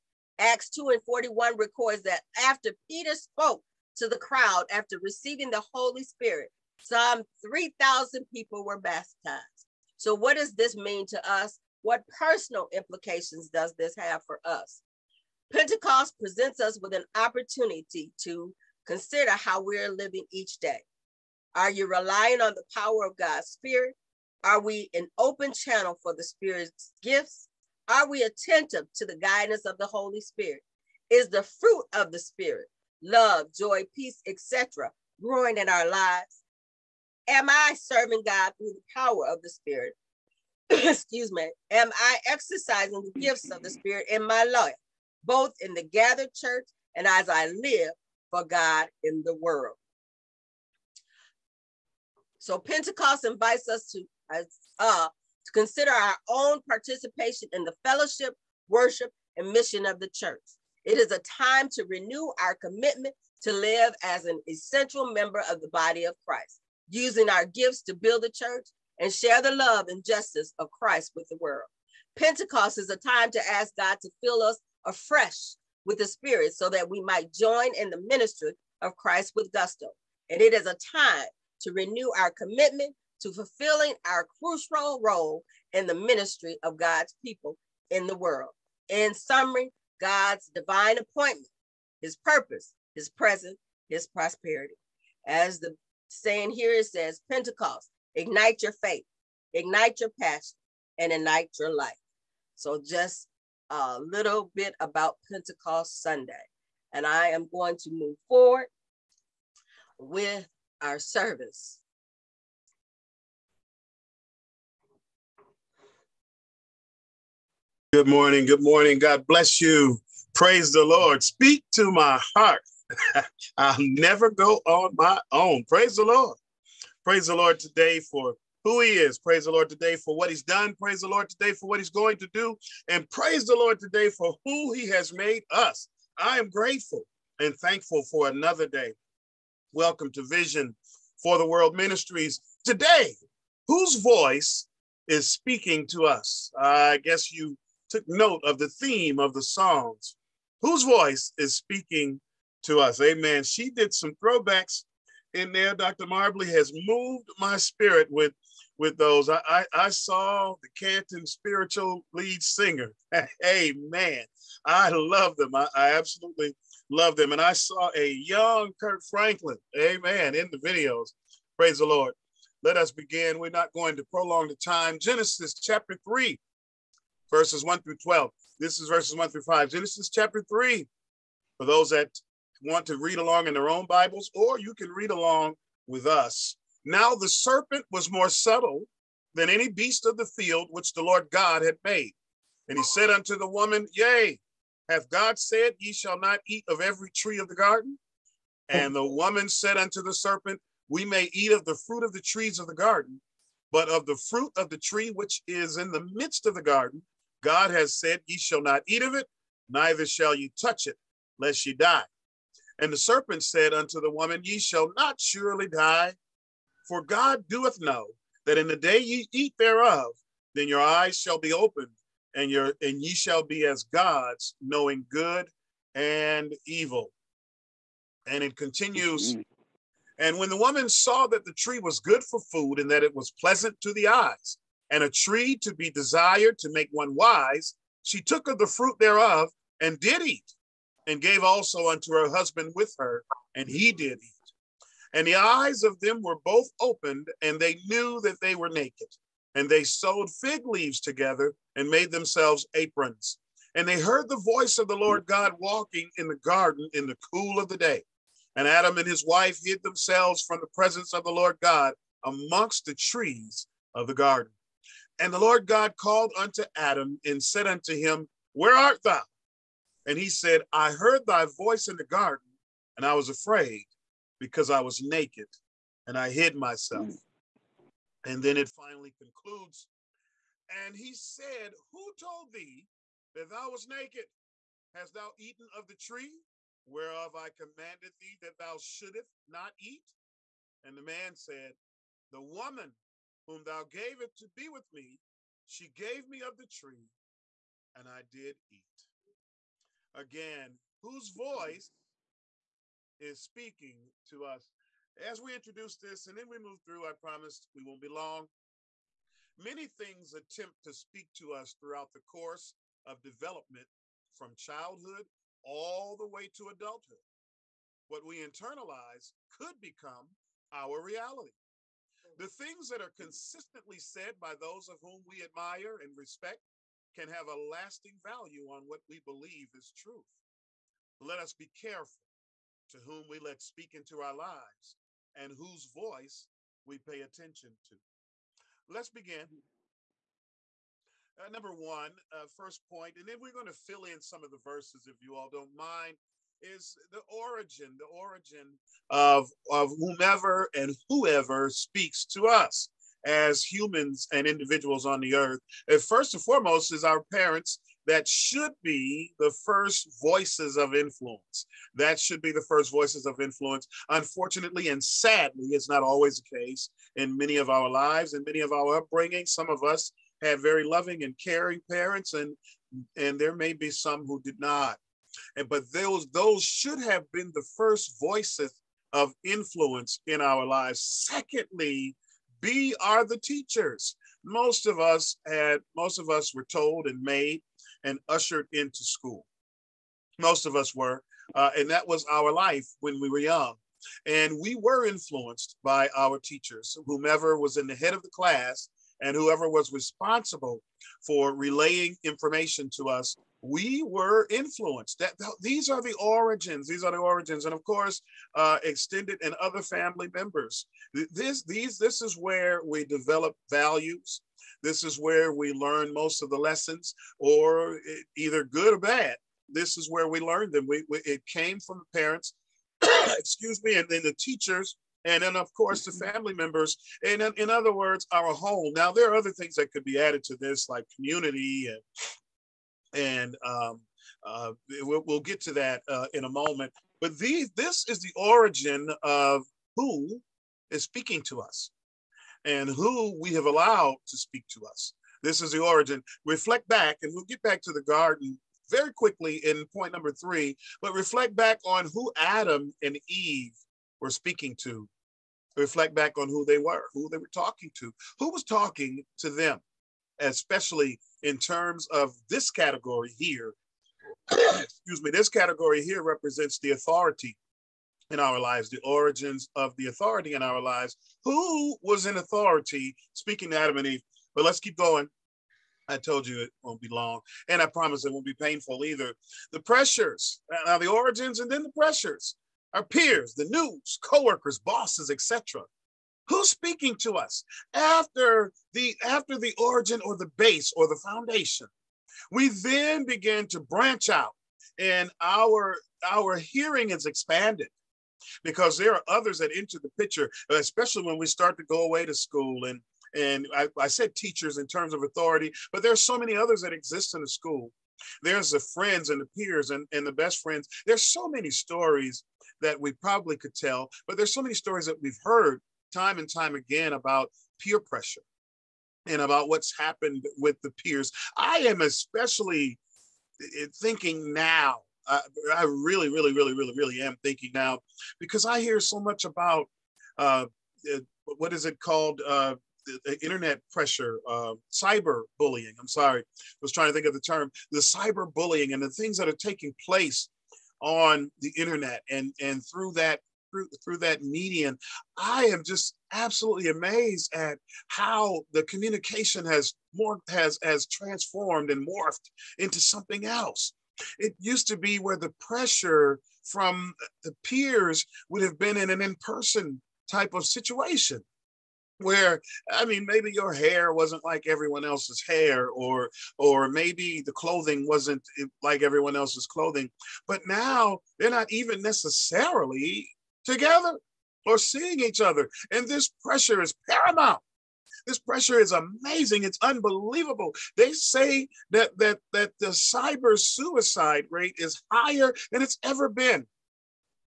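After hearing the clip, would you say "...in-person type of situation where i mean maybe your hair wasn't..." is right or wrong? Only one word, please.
right.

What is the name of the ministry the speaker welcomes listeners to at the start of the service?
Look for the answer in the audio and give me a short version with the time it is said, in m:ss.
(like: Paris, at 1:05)
Vision for the World Ministries, at 2:20.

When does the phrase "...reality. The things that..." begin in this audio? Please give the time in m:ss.
5:21.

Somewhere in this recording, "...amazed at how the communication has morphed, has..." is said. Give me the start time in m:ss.
9:06.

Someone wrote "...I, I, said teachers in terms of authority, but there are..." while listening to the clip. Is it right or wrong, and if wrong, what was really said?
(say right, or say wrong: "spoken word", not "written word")
right.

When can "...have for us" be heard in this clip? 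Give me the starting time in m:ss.
0:13.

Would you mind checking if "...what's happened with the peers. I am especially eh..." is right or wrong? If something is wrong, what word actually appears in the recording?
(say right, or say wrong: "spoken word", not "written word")
right.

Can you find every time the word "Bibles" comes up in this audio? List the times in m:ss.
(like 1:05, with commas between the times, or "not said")
3:03.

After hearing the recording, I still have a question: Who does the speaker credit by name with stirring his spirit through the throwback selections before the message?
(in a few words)
Dr. Marbley.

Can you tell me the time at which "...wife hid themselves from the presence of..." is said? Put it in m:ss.
4:19.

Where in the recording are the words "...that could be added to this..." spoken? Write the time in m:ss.
7:09.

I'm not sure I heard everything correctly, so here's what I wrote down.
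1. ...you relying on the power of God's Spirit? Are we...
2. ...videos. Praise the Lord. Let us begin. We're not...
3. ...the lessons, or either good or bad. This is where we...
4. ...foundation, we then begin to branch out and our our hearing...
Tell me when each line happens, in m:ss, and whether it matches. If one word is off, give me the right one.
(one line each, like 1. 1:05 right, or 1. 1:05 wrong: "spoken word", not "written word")
1. 0:21 right
2. 2:50 right
3. 6:56 right
4. 8:11 right.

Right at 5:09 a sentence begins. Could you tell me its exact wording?
Many things attempt to speak to us throughout the course of development from childhood all the way to adulthood.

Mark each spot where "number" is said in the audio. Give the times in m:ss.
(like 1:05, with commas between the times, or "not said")
5:41, 7:30.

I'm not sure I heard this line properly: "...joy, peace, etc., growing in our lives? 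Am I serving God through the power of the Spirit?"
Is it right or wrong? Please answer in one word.
right.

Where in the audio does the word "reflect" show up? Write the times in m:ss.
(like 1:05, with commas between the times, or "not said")
7:26, 7:31, 7:35.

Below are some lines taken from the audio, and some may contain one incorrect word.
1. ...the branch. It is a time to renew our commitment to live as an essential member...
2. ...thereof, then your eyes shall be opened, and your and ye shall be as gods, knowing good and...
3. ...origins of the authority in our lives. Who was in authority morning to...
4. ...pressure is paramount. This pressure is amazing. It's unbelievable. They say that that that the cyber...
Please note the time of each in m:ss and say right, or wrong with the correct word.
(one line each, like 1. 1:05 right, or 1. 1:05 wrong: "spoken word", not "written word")
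1. 0:59 wrong: "church", not "branch"
2. 3:39 right
3. 7:49 wrong: "speaking", not "morning"
4. 9:36 right.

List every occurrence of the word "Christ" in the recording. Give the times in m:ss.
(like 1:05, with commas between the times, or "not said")
1:06, 1:10, 1:18.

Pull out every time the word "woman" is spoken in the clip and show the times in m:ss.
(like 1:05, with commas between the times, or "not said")
3:13, 3:19, 3:34, 3:50, 4:52.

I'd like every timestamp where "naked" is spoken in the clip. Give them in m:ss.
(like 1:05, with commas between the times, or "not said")
4:08, 4:35, 4:43.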